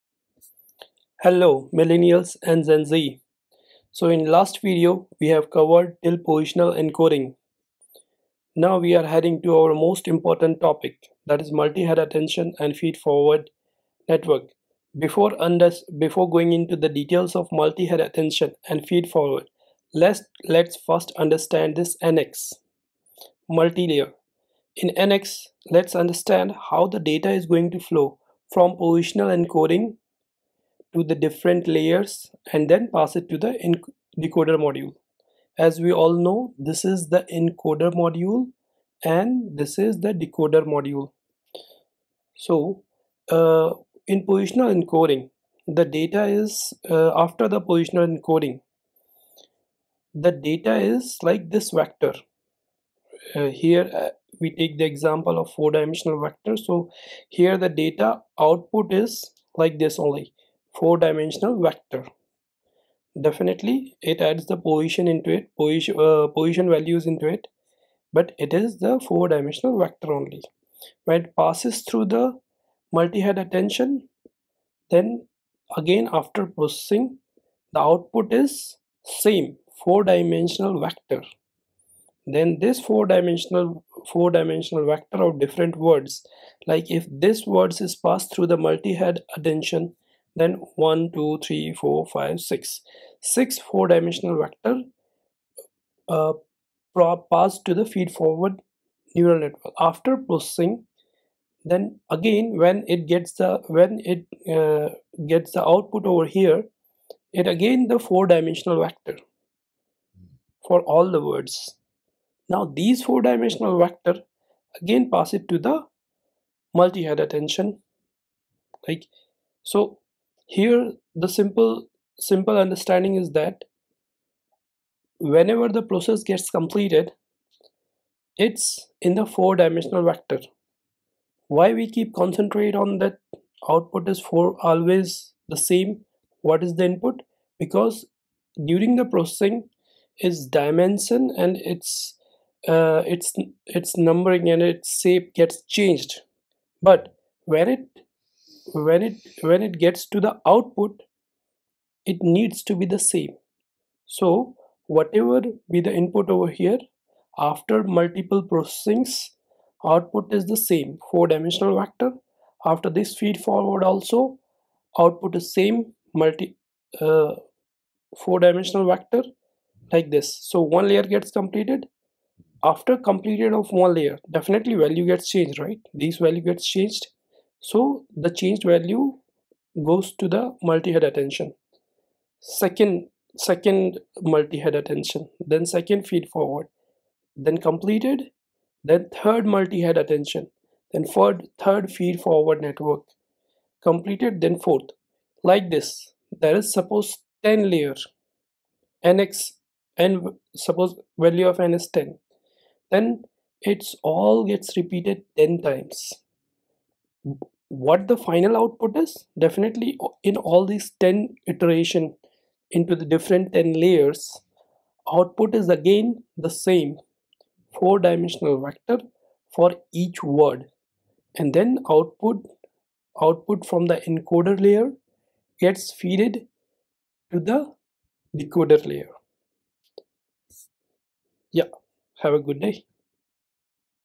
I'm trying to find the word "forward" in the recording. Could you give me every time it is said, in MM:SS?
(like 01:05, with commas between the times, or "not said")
00:12, 00:18, 01:38, 02:43, 03:06, 03:12.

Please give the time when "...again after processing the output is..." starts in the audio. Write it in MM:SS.
01:15.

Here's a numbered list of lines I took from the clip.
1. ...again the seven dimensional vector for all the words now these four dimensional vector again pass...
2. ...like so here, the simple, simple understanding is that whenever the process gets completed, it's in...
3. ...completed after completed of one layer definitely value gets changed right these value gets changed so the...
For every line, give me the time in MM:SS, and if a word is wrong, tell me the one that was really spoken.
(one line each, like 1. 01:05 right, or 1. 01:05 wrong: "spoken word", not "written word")
1. 01:47 wrong: "four", not "seven"
2. 01:58 right
3. 02:51 right.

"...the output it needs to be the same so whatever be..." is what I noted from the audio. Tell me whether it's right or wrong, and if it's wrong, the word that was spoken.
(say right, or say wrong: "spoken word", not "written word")
right.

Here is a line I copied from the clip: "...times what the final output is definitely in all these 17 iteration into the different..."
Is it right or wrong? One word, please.
wrong.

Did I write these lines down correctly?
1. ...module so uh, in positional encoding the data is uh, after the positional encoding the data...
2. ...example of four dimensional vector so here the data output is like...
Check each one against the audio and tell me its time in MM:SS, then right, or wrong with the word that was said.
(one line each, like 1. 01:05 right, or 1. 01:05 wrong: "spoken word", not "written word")
1. 00:40 right
2. 00:54 right.